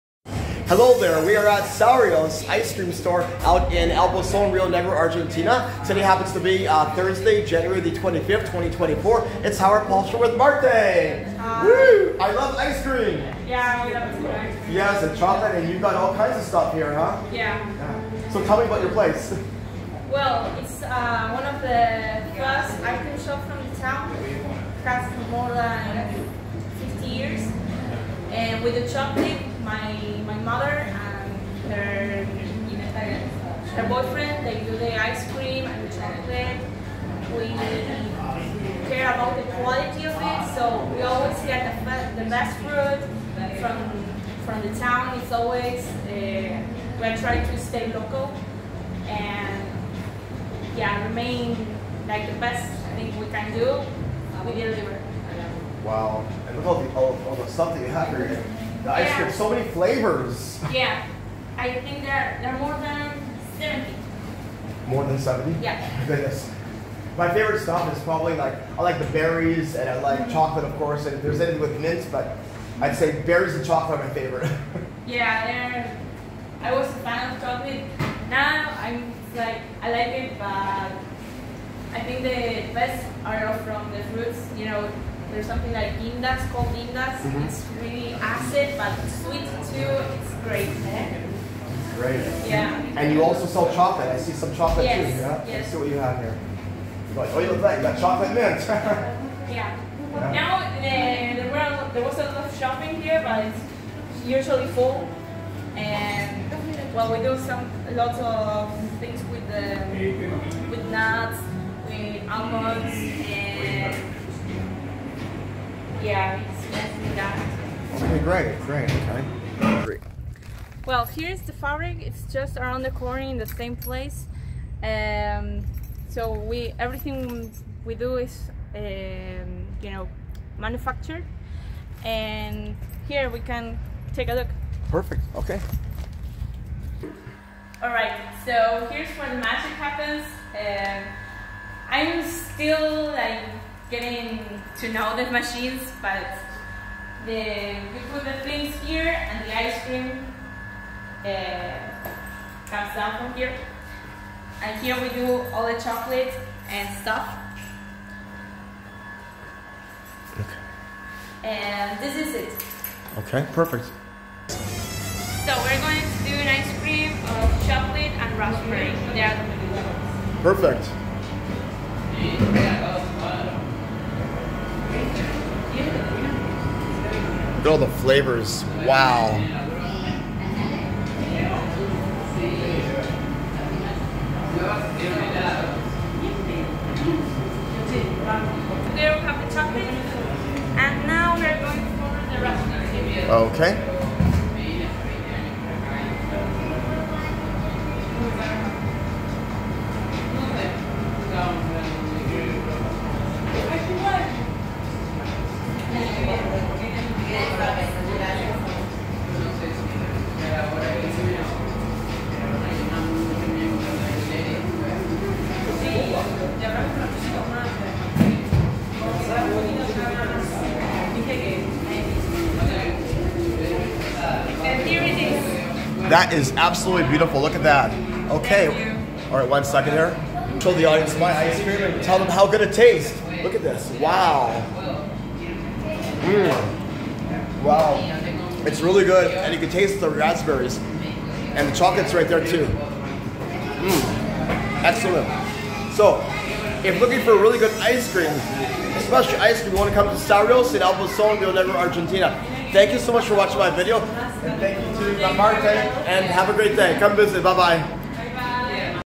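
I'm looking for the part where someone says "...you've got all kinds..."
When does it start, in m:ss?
0:15.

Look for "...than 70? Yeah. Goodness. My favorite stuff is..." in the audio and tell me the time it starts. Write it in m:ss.
1:05.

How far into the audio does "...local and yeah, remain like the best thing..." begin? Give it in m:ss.
0:47.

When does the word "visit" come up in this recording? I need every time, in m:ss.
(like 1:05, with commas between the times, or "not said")
4:17.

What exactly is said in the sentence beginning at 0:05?
Today happens to be uh, Thursday, January the 25th, 2024.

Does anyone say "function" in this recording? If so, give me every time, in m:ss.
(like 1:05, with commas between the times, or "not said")
not said.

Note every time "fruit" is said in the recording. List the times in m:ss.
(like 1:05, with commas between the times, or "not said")
0:42, 1:24.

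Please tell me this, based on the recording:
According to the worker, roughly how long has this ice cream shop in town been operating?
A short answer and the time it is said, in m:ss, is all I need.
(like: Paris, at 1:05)
more than 50 years, at 0:25.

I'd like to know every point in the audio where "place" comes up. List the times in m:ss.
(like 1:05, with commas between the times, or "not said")
0:18, 2:03.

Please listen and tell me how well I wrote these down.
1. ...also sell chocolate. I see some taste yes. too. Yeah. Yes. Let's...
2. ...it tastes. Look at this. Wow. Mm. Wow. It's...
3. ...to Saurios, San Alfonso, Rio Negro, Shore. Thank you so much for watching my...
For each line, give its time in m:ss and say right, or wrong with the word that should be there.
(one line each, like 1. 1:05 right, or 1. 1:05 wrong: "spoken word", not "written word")
1. 1:33 wrong: "chocolate", not "taste"
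2. 3:52 right
3. 4:10 wrong: "Argentina", not "Shore".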